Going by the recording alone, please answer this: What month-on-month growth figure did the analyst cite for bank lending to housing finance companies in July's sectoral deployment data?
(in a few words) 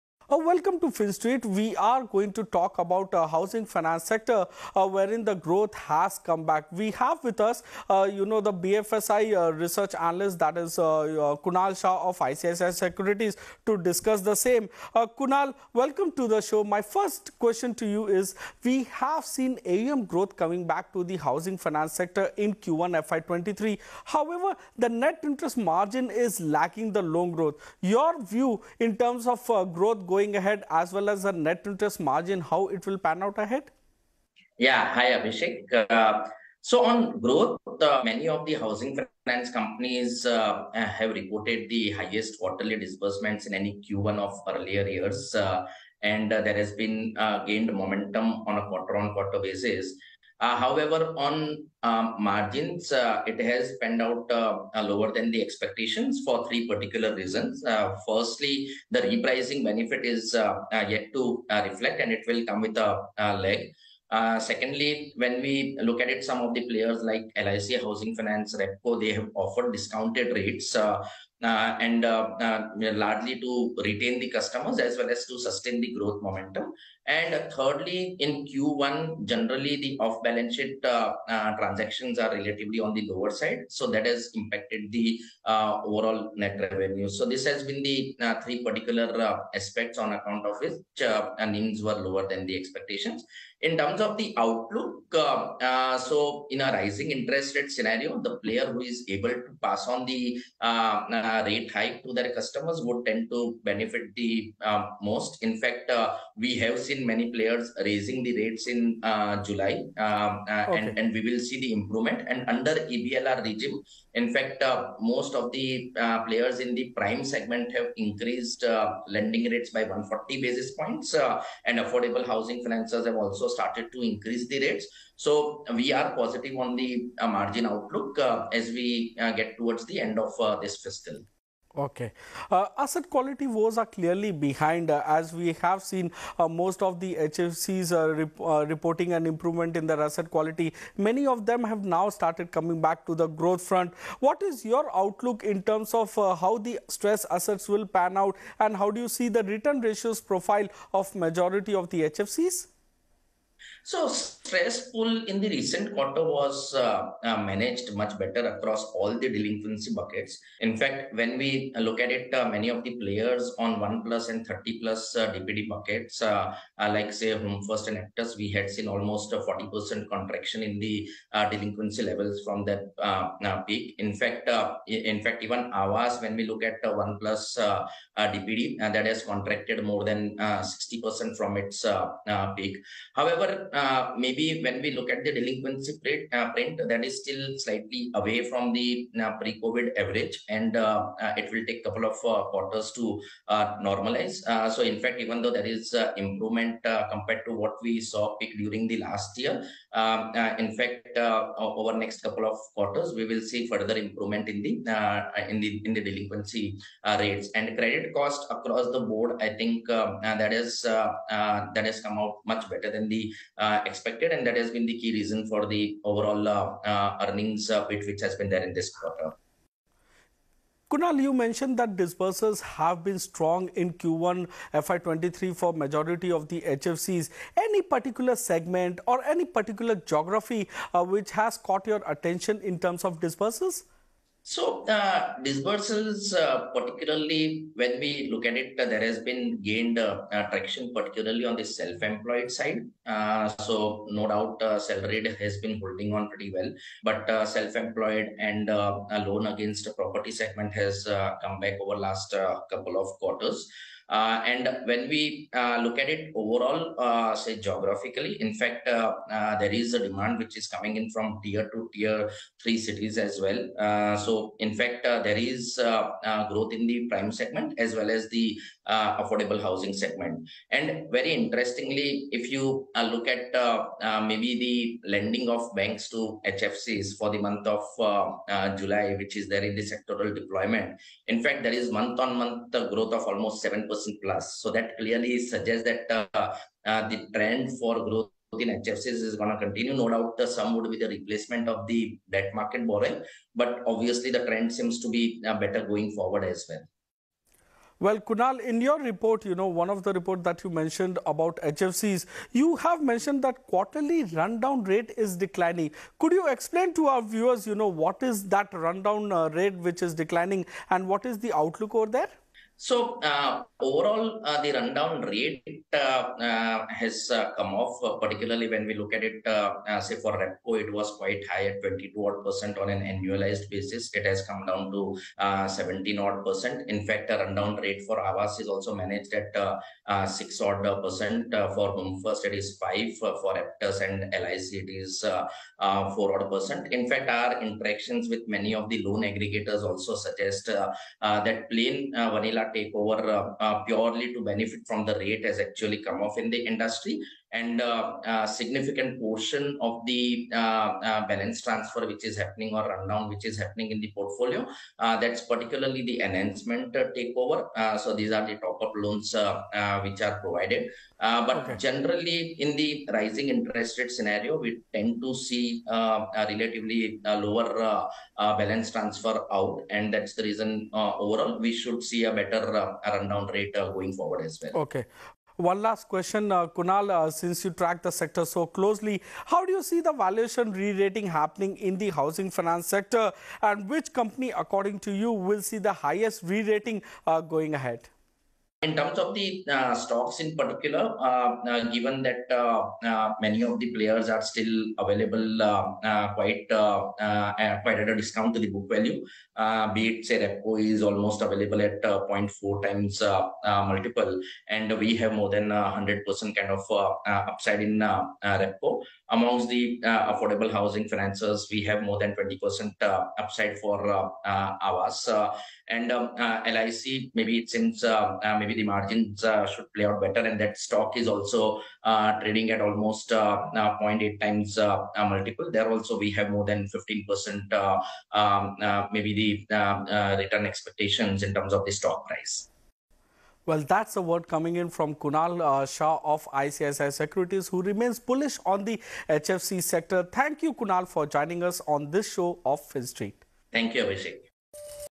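7%.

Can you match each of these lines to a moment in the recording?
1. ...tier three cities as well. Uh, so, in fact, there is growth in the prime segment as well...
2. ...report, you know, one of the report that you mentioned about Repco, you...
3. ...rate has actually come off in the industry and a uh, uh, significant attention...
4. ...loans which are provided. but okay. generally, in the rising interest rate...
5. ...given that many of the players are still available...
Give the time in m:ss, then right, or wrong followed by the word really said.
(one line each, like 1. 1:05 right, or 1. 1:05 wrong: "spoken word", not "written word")
1. 4:21 right
2. 4:58 wrong: "HFCs", not "Repco"
3. 5:45 wrong: "portion", not "attention"
4. 5:58 right
5. 6:31 right.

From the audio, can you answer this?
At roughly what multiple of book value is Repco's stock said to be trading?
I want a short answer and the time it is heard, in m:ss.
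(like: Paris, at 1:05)
0.4 times, at 6:42.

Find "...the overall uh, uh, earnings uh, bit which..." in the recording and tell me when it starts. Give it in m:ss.
3:35.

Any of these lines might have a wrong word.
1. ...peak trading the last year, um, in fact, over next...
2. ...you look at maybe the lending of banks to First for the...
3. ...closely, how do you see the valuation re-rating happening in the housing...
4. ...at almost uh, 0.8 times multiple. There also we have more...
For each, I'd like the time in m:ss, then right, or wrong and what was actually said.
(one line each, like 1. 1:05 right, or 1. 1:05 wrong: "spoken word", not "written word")
1. 3:18 wrong: "during", not "trading"
2. 4:32 wrong: "HFCs", not "First"
3. 6:18 right
4. 7:02 right.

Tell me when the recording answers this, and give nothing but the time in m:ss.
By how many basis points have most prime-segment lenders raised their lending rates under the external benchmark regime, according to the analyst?
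1:59.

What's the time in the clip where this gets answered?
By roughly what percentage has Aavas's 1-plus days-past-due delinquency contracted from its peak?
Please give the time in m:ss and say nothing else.
2:59.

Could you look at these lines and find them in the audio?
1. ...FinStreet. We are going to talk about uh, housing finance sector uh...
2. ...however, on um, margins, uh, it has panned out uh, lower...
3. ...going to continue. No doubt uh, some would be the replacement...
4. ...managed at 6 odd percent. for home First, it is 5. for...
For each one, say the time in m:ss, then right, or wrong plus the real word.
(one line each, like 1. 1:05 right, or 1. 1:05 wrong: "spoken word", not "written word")
1. 0:00 right
2. 0:50 right
3. 4:49 right
4. 5:28 right.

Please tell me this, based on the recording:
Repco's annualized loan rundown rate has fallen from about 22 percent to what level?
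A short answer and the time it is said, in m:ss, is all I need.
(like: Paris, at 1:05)
17%, at 5:25.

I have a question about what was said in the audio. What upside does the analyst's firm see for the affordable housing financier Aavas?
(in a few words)
more than 20%.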